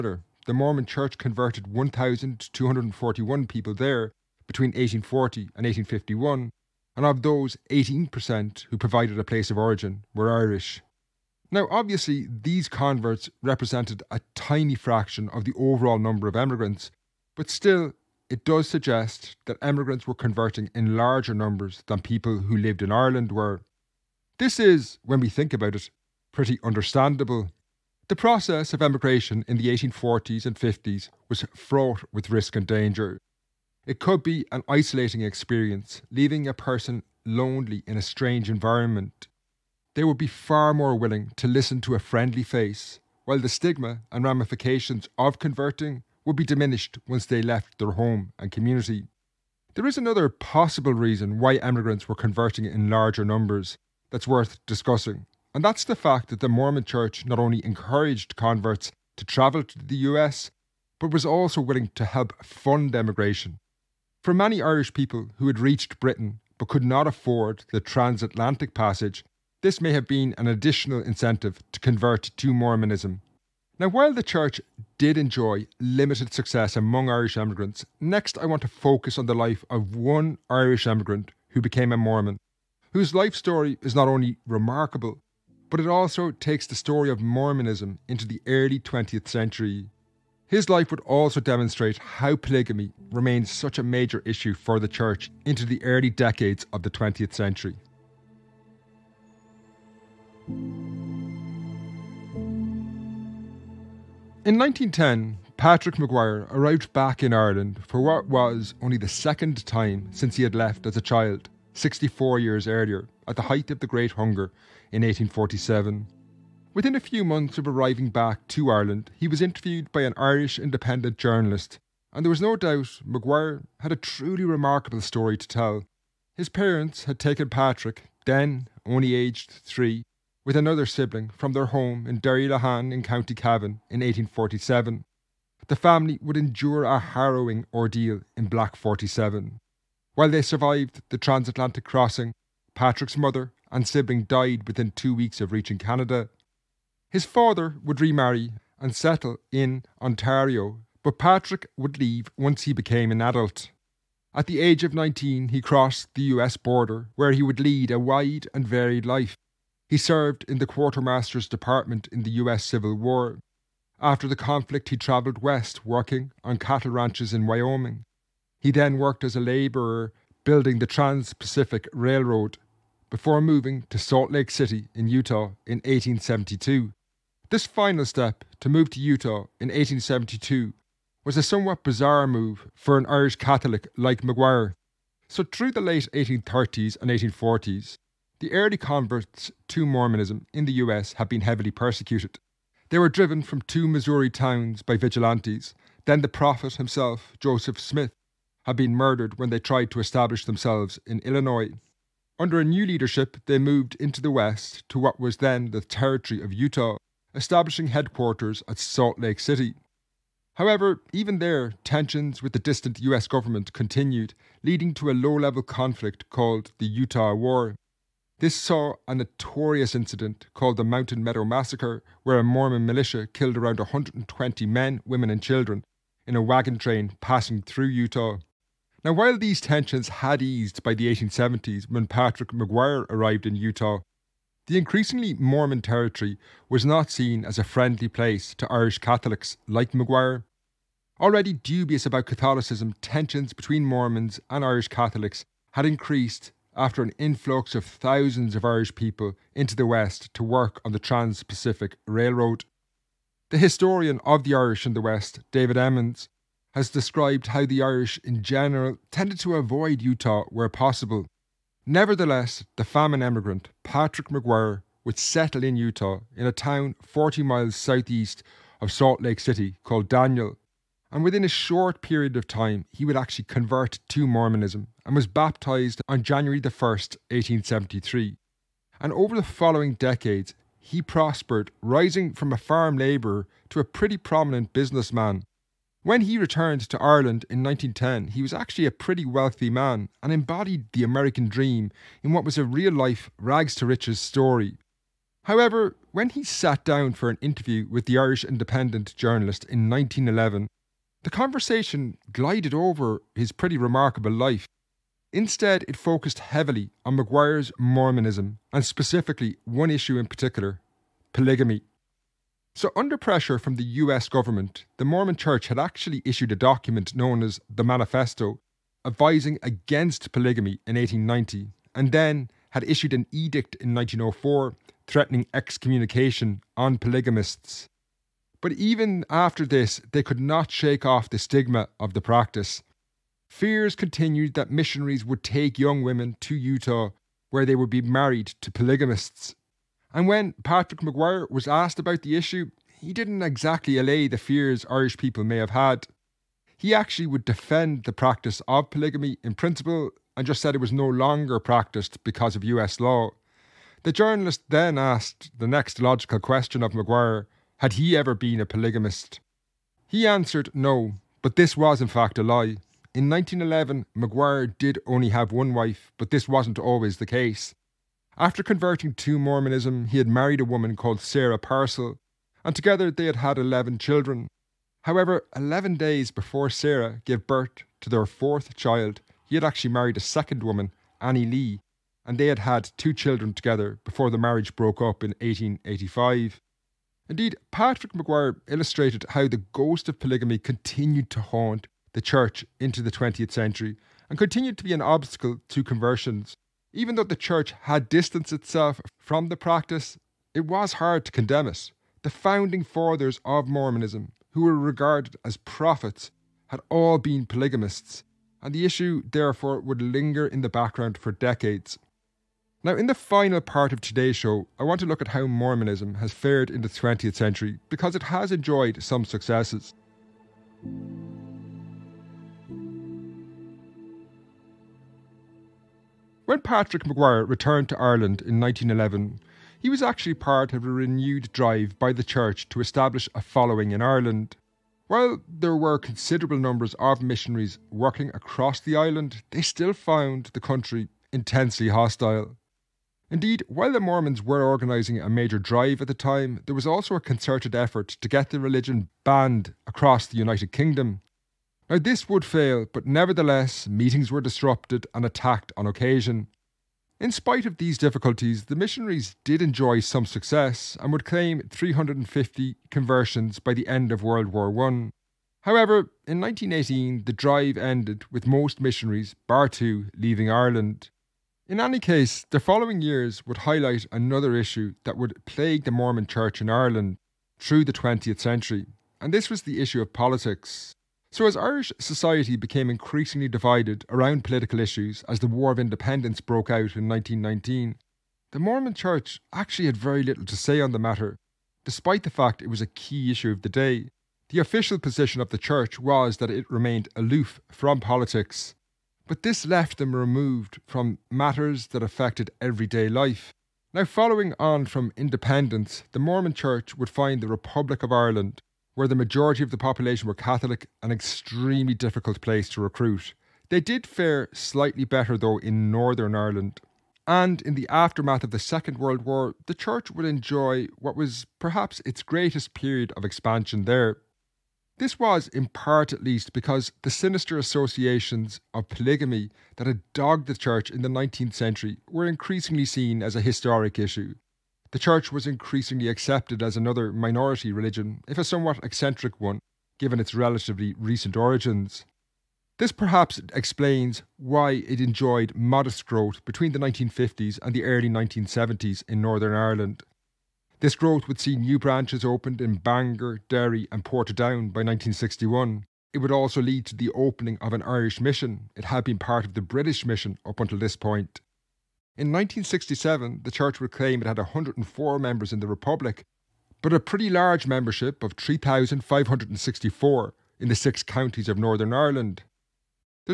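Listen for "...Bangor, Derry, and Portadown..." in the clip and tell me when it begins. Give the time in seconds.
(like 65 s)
552 s.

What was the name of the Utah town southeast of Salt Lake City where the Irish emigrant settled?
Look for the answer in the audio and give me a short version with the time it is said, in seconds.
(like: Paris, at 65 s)
Daniel, at 270 s.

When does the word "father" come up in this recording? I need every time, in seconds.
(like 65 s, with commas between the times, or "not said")
147 s, 402 s.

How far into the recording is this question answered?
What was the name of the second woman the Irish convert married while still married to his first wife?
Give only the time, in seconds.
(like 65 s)
381 s.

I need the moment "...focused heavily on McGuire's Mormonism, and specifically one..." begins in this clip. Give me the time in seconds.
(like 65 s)
305 s.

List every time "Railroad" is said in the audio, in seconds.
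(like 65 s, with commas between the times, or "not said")
171 s, 252 s.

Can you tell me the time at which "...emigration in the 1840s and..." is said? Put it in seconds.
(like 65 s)
28 s.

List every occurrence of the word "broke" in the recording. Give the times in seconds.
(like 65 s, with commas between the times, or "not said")
384 s, 486 s.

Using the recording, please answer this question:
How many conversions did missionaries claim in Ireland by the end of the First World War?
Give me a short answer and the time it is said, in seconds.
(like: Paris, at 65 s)
350, at 461 s.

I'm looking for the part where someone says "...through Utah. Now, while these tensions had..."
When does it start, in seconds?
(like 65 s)
227 s.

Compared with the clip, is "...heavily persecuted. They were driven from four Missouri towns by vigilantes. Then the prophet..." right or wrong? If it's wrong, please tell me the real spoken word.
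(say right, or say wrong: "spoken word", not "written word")
wrong: "two", not "four".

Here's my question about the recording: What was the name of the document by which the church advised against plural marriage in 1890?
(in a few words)
the Manifesto.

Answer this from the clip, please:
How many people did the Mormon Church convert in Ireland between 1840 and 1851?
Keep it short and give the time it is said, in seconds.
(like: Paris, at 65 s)
1,241, at 1 s.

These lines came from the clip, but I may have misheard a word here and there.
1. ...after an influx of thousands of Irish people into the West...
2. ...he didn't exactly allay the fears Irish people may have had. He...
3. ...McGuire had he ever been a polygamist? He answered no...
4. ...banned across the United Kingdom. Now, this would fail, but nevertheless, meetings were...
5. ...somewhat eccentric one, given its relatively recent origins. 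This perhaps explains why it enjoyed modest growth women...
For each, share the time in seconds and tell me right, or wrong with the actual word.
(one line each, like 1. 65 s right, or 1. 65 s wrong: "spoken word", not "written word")
1. 246 s right
2. 342 s right
3. 356 s right
4. 449 s right
5. 538 s wrong: "between", not "women".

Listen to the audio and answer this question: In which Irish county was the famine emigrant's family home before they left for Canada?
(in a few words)
County Cavan.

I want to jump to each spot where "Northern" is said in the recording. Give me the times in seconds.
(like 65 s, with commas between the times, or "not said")
515 s, 549 s, 571 s.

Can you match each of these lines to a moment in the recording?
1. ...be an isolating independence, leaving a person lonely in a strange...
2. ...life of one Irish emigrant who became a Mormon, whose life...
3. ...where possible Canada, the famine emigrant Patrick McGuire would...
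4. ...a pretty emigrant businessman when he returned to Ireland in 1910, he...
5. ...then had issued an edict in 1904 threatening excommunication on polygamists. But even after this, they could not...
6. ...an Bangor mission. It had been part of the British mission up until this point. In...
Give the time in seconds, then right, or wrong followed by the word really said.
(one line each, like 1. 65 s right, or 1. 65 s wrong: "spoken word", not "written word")
1. 34 s wrong: "experience", not "independence"
2. 79 s right
3. 260 s wrong: "Nevertheless", not "Canada"
4. 283 s wrong: "prominent", not "emigrant"
5. 322 s right
6. 557 s wrong: "Irish", not "Bangor".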